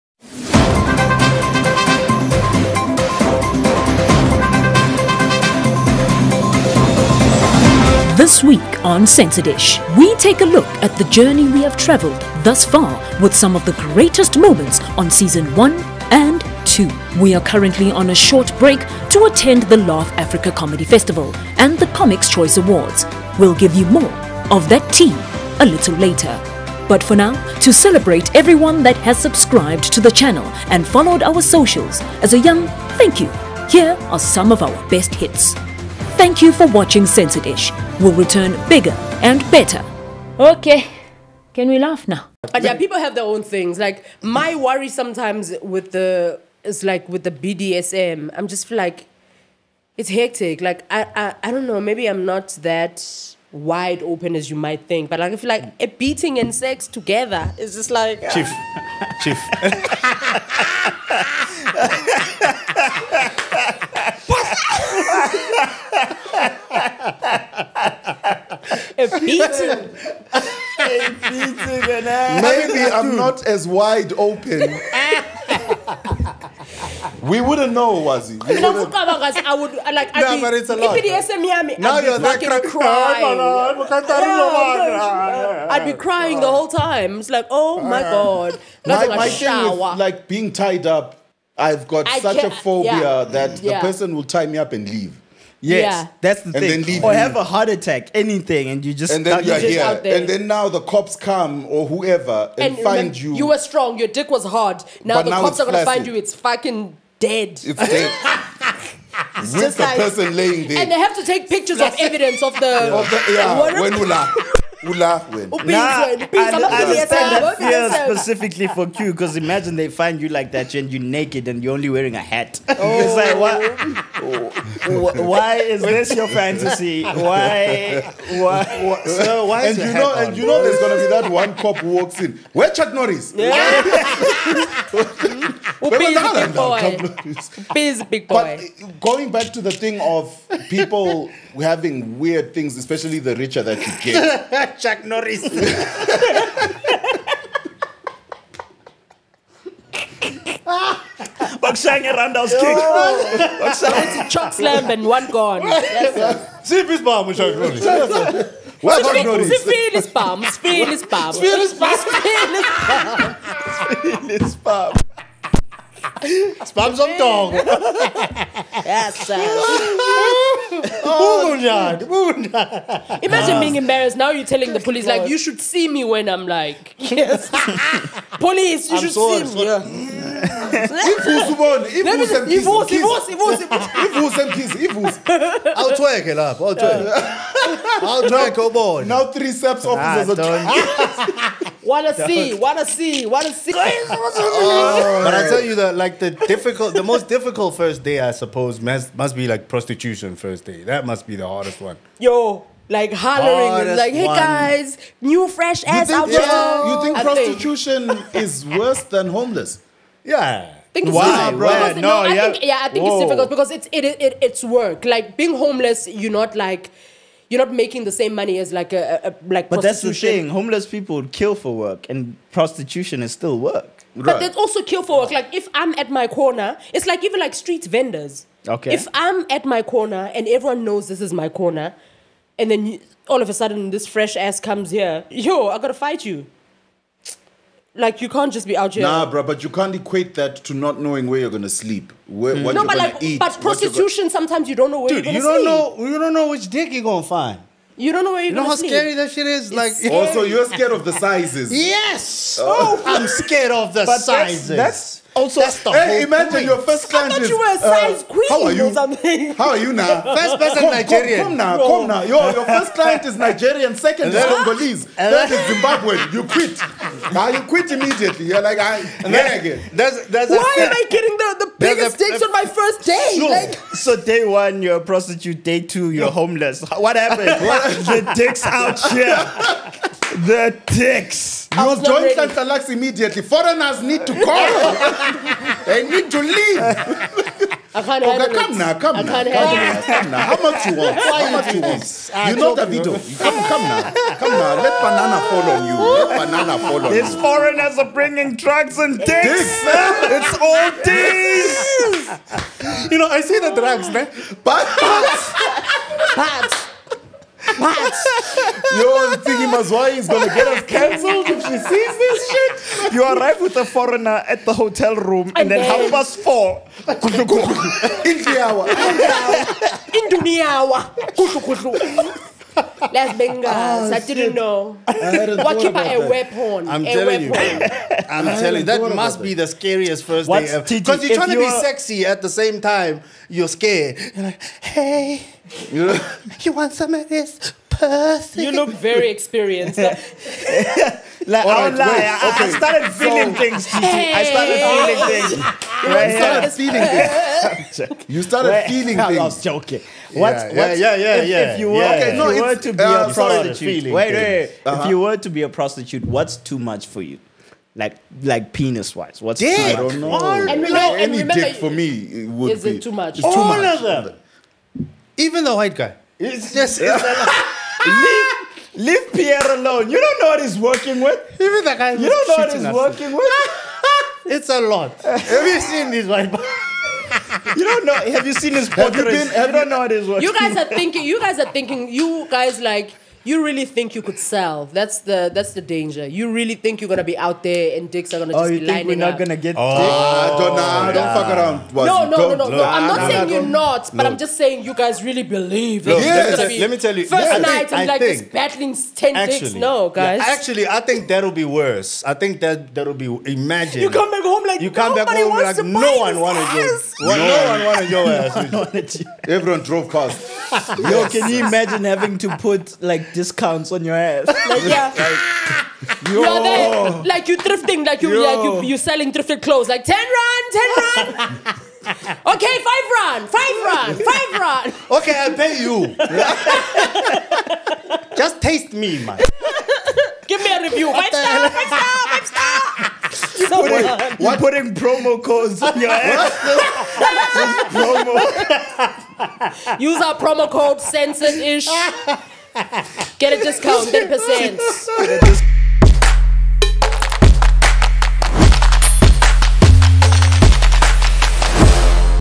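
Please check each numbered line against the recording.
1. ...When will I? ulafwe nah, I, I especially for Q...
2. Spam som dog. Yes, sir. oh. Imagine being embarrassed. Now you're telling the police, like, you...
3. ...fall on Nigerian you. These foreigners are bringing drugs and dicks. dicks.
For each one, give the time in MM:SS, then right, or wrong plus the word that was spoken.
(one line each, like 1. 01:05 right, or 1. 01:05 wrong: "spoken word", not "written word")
1. 01:53 wrong: "specifically", not "especially"
2. 02:46 right
3. 04:56 wrong: "These", not "Nigerian".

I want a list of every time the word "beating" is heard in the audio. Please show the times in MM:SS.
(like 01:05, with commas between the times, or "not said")
00:55, 01:09.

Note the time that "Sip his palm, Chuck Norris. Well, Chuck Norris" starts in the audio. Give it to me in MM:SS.
02:36.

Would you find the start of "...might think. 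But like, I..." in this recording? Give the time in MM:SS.
00:54.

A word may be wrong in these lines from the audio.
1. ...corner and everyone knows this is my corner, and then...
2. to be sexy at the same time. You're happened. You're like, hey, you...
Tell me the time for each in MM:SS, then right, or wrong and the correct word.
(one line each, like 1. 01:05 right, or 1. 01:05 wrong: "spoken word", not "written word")
1. 03:49 right
2. 05:31 wrong: "scared", not "happened".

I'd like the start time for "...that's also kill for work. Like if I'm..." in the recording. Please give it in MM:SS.
03:44.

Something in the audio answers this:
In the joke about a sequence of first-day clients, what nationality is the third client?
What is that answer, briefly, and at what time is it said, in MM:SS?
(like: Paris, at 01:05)
Zimbabwean, at 04:25.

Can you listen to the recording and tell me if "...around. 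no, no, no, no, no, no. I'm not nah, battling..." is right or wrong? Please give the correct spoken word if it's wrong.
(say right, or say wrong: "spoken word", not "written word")
wrong: "saying", not "battling".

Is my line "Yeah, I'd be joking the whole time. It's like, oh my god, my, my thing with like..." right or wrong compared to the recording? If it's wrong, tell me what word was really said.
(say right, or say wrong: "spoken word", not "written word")
wrong: "crying", not "joking".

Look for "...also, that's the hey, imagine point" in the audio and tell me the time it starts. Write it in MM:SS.
04:15.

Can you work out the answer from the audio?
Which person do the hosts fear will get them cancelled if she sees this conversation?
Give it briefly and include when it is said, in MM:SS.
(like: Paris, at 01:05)
Mazwai, at 05:09.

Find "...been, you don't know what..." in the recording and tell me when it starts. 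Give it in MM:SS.
06:19.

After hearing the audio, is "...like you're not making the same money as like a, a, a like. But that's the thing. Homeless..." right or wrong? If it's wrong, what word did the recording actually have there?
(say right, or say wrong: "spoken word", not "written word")
right.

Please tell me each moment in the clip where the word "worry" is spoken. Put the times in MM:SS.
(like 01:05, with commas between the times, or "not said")
00:44.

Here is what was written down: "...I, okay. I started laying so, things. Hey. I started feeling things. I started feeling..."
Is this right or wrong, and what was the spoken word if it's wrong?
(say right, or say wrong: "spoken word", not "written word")
wrong: "feeling", not "laying".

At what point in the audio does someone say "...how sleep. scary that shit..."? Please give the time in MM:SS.
04:08.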